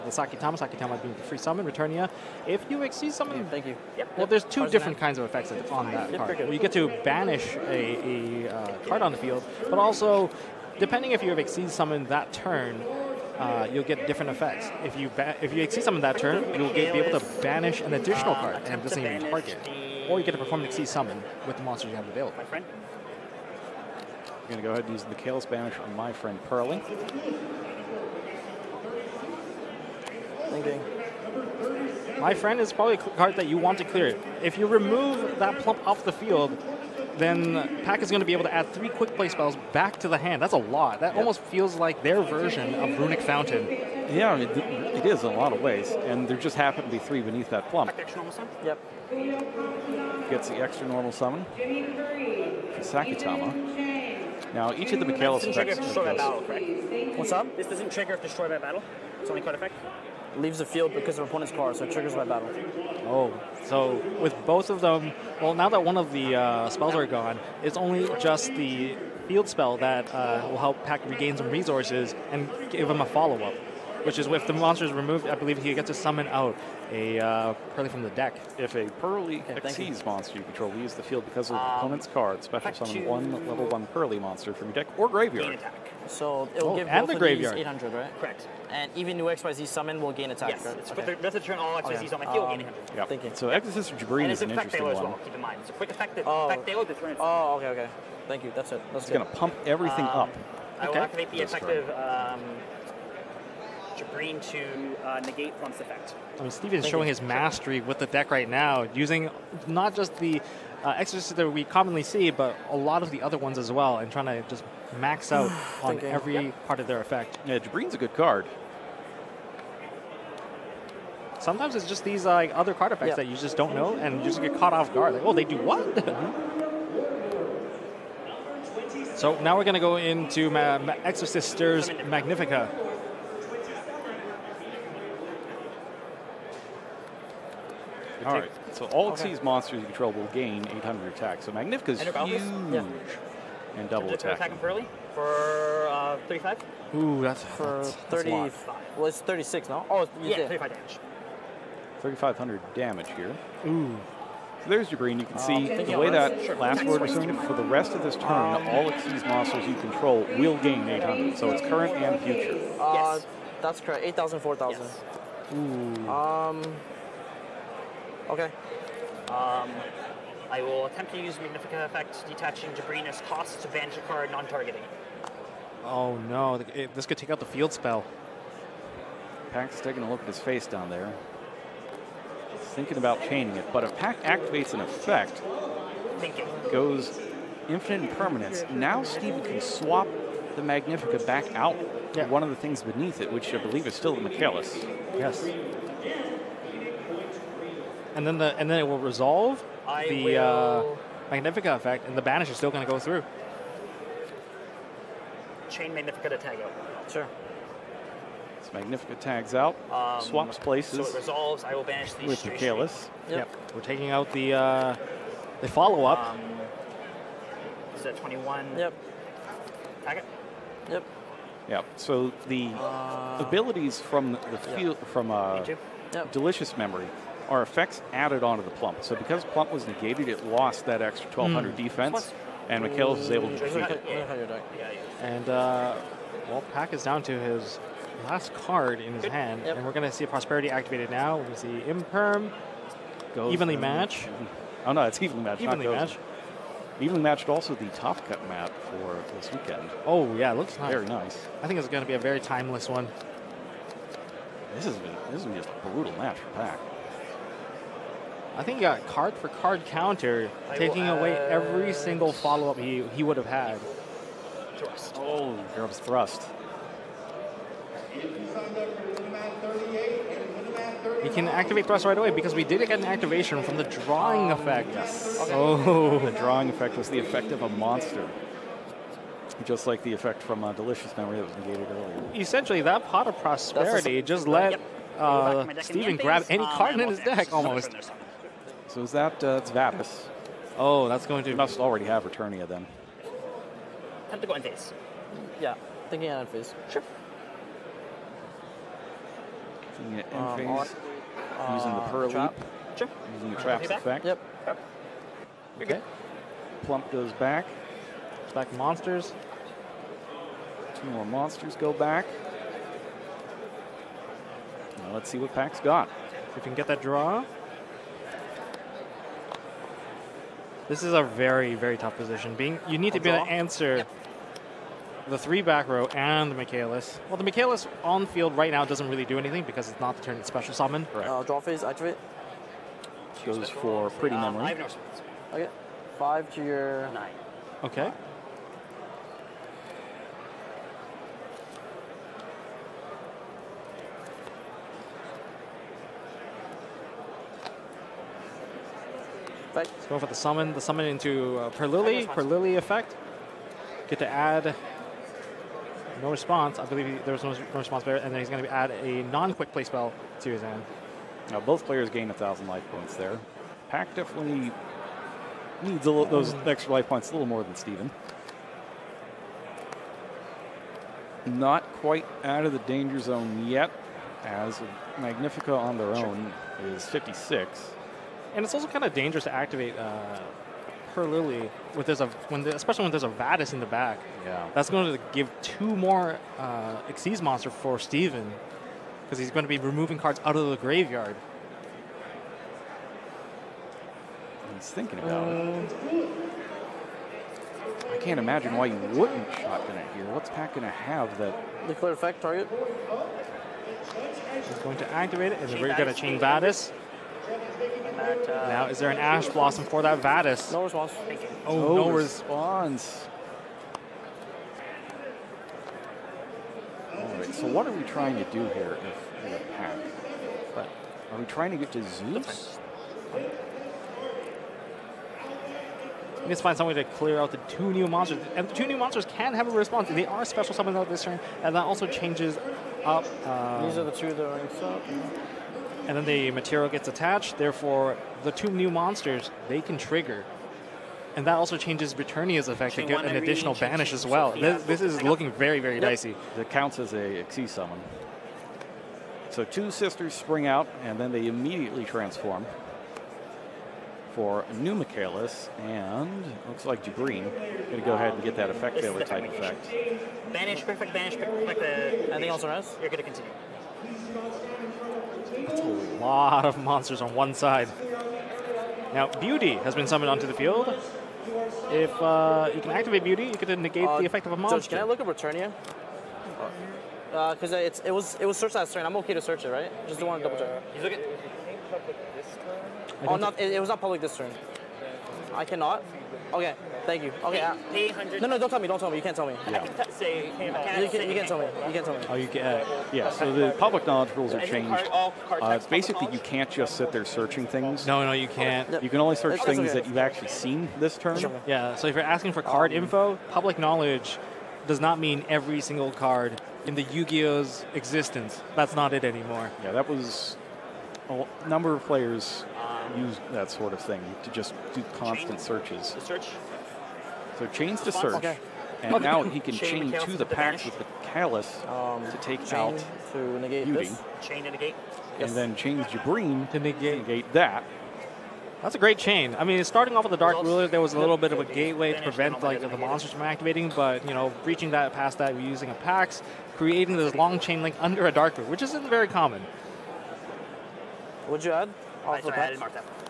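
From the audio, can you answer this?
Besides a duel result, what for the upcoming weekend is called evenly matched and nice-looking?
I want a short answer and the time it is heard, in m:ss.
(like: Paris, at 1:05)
Top Cut map, at 4:07.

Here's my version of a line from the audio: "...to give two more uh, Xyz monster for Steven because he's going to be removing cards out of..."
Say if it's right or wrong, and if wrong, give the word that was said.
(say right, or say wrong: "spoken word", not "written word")
right.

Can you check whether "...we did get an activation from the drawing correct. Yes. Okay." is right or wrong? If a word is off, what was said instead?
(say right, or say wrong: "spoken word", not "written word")
wrong: "effect", not "correct".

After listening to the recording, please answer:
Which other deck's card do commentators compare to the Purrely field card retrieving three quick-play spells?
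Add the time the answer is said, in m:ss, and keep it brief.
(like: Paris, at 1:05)
Runick Fountain, at 0:42.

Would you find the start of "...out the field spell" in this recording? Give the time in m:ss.
2:57.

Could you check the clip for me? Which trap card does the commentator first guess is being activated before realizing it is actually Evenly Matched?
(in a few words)
Imperm.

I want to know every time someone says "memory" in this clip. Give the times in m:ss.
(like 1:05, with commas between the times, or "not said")
3:46, 4:41, 5:34.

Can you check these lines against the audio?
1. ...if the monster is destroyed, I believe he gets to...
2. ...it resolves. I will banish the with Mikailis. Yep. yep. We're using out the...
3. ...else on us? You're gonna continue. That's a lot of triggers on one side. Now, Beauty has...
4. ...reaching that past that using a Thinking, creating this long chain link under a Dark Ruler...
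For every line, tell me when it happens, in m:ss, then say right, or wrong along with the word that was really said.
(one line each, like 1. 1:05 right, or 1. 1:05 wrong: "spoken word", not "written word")
1. 1:14 wrong: "removed", not "destroyed"
2. 3:31 wrong: "taking", not "using"
3. 7:42 wrong: "monsters", not "triggers"
4. 8:54 wrong: "Pax", not "Thinking".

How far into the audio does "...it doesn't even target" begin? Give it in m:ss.
0:18.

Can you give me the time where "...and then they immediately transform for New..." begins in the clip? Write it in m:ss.
7:31.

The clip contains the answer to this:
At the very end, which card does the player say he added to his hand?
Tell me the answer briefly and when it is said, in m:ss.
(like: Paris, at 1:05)
Martha, at 9:02.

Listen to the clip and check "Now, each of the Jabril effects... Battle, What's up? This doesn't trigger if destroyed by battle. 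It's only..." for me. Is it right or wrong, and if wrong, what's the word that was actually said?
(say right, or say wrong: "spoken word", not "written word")
wrong: "Mikailis", not "Jabril".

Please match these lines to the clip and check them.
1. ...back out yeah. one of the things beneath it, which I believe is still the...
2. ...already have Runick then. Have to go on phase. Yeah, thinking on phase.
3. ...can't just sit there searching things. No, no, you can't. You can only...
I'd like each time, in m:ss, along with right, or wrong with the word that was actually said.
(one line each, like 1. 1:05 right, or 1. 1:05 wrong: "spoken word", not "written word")
1. 3:11 right
2. 4:51 wrong: "Returnia", not "Runick"
3. 8:16 right.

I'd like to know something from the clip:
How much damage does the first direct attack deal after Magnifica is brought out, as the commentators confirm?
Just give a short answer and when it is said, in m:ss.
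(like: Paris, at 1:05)
3,500, at 2:32.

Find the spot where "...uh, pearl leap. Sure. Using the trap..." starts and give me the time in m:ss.
5:01.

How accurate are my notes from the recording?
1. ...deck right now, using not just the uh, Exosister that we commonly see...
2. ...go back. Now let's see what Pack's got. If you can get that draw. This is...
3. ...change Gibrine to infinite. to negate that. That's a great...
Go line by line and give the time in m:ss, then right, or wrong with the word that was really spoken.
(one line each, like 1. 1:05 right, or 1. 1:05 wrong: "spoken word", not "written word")
1. 1:48 right
2. 5:11 right
3. 8:45 wrong: "negate", not "infinite".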